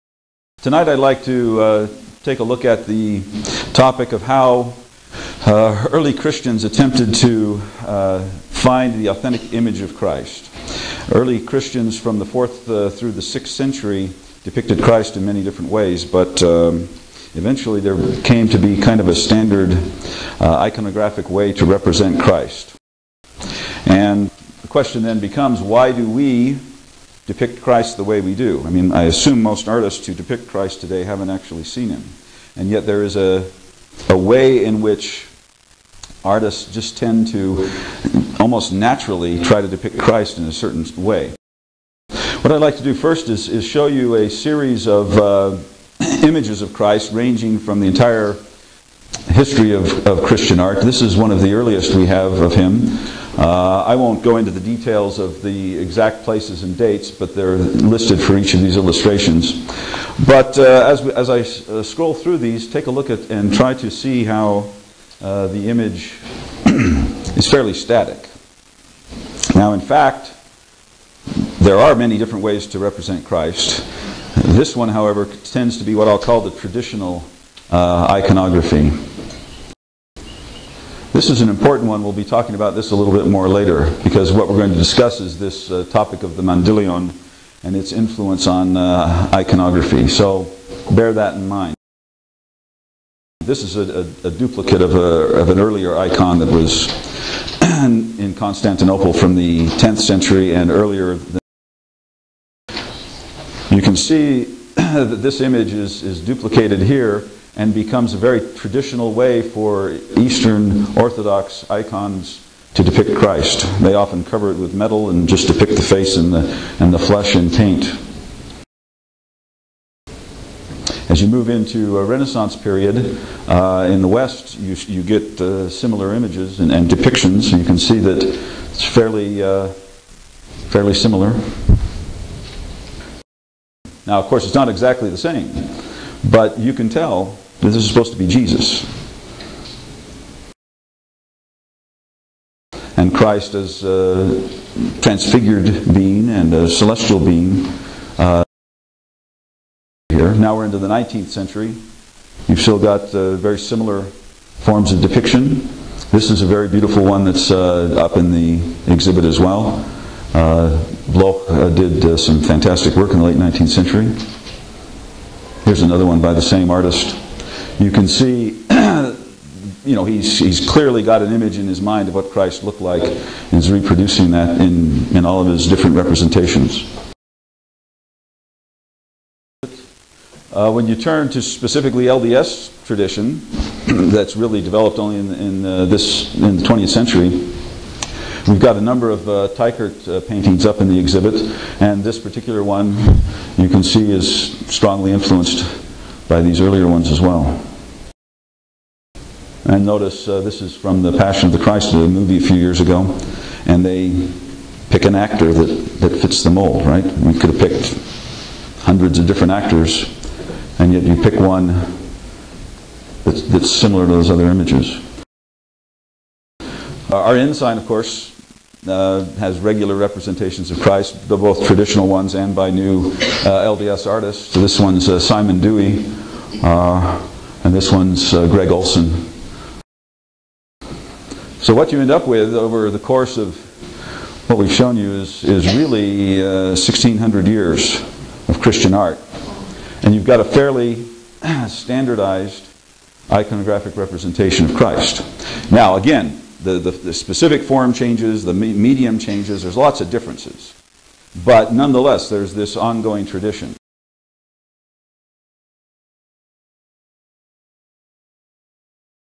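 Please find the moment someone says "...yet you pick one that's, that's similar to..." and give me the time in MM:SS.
03:30.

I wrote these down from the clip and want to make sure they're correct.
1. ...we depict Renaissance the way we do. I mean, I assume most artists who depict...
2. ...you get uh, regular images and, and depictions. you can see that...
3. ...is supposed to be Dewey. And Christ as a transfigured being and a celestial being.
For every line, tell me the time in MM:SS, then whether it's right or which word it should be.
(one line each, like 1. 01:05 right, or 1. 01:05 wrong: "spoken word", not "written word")
1. 00:26 wrong: "Christ", not "Renaissance"
2. 02:04 wrong: "similar", not "regular"
3. 02:17 wrong: "Jesus", not "Dewey".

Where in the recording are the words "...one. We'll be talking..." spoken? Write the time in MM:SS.
01:21.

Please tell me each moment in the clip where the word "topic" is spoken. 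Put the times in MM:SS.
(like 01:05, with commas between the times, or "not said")
00:03, 01:25.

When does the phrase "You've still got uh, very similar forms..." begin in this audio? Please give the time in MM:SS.
02:32.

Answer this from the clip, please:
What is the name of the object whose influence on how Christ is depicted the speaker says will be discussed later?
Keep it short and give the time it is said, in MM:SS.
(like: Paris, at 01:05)
Mandilion, at 01:26.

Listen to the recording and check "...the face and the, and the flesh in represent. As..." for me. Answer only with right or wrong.
wrong.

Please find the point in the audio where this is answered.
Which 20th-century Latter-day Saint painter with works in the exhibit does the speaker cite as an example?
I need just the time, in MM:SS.
03:09.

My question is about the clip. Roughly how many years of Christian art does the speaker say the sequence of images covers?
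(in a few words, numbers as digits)
1600 years.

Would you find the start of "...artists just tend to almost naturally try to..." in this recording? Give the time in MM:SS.
00:36.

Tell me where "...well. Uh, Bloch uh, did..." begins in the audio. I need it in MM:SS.
02:39.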